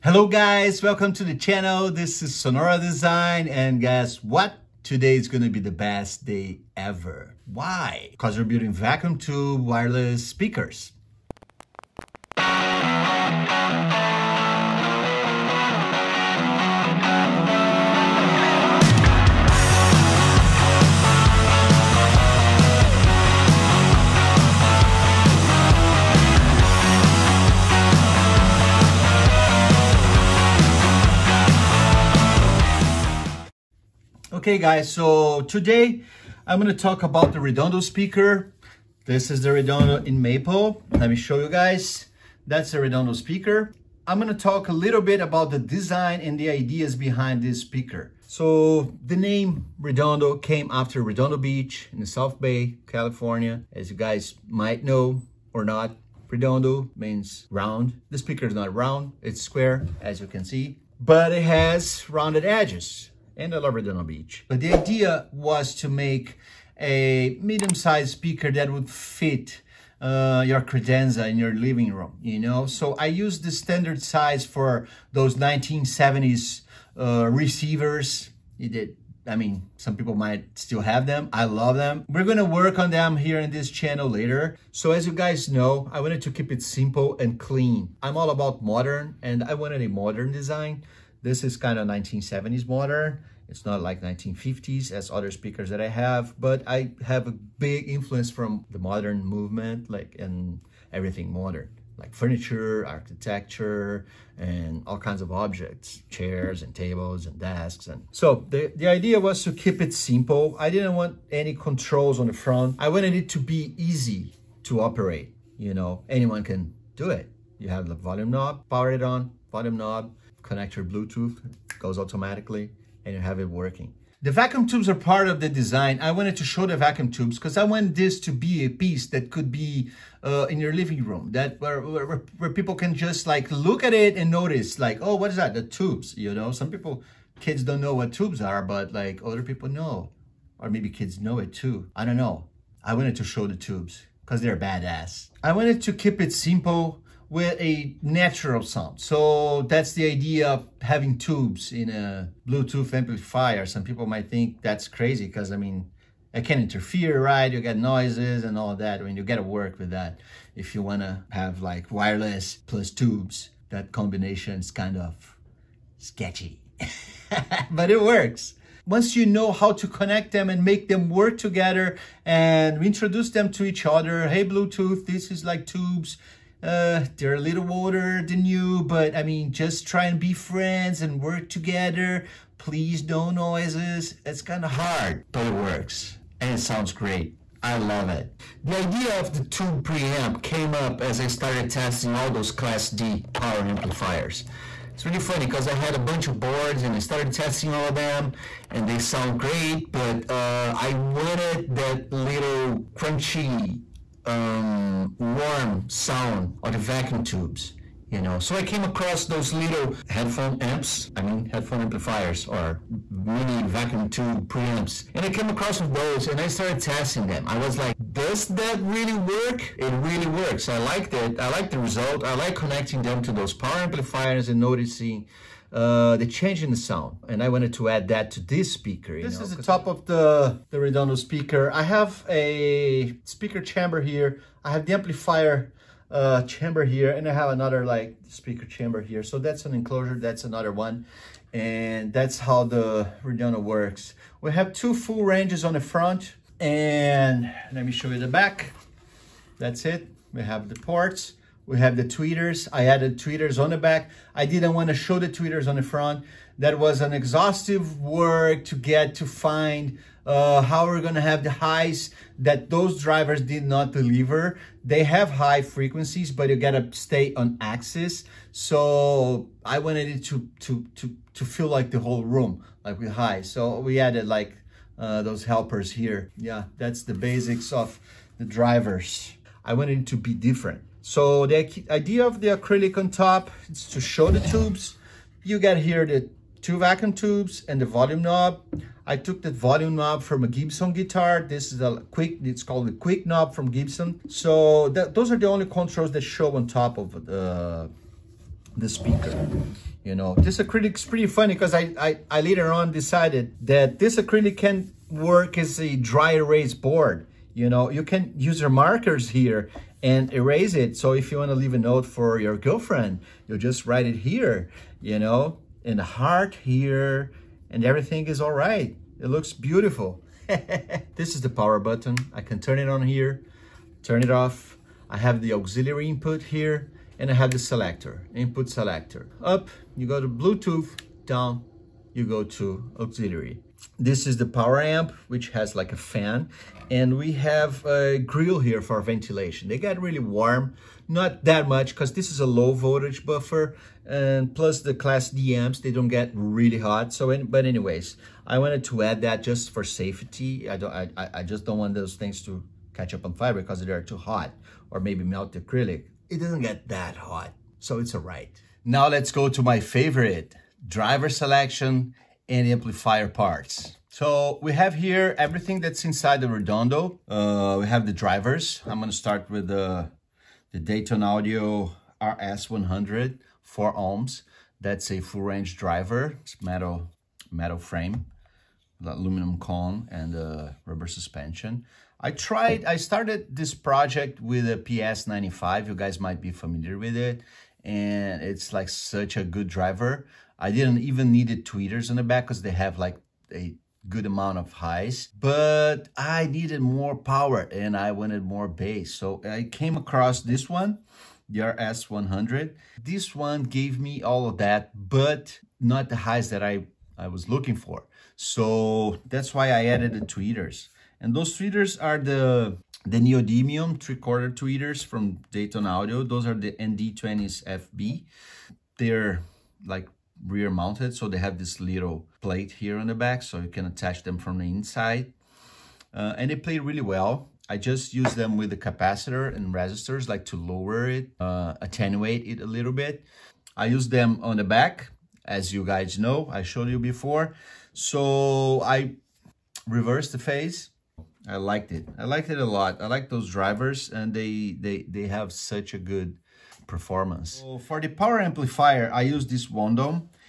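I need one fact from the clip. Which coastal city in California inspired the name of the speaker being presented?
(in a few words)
Redondo Beach.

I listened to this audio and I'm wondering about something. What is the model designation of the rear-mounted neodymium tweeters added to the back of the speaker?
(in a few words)
ND20s FB.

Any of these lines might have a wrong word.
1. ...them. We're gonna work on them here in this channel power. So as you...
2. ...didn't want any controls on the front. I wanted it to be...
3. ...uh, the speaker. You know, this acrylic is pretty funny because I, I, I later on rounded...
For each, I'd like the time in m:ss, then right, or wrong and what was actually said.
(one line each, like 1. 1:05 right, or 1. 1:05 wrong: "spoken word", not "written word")
1. 1:21 wrong: "later", not "power"
2. 1:50 right
3. 4:57 wrong: "decided", not "rounded".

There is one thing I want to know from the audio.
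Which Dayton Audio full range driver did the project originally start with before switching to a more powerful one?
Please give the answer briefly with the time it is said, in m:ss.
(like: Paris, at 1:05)
PS95, at 6:24.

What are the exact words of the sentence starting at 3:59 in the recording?
So that's an enclosure, that's another one.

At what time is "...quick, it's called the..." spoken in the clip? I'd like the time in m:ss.
4:52.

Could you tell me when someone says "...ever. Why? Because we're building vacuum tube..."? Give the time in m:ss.
0:06.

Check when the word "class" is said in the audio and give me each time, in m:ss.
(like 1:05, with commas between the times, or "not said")
3:12, 5:44.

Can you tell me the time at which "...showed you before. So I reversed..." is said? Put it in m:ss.
7:16.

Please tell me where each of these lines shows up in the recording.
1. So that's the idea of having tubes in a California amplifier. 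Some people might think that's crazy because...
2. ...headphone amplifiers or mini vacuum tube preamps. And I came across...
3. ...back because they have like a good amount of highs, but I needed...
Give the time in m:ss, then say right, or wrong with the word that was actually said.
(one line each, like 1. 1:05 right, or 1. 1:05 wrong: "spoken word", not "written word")
1. 2:28 wrong: "Bluetooth", not "California"
2. 3:31 right
3. 6:32 right.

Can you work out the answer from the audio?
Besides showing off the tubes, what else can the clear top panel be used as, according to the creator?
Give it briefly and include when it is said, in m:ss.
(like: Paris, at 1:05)
dry erase board, at 5:05.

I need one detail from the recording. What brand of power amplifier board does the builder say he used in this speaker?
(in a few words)
Wondom.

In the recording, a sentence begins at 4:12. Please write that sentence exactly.
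I added tweeters on the back.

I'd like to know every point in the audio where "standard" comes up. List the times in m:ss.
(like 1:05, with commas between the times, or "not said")
1:13.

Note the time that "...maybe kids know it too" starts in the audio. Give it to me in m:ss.
2:20.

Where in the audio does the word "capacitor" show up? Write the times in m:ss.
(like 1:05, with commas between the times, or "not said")
7:08.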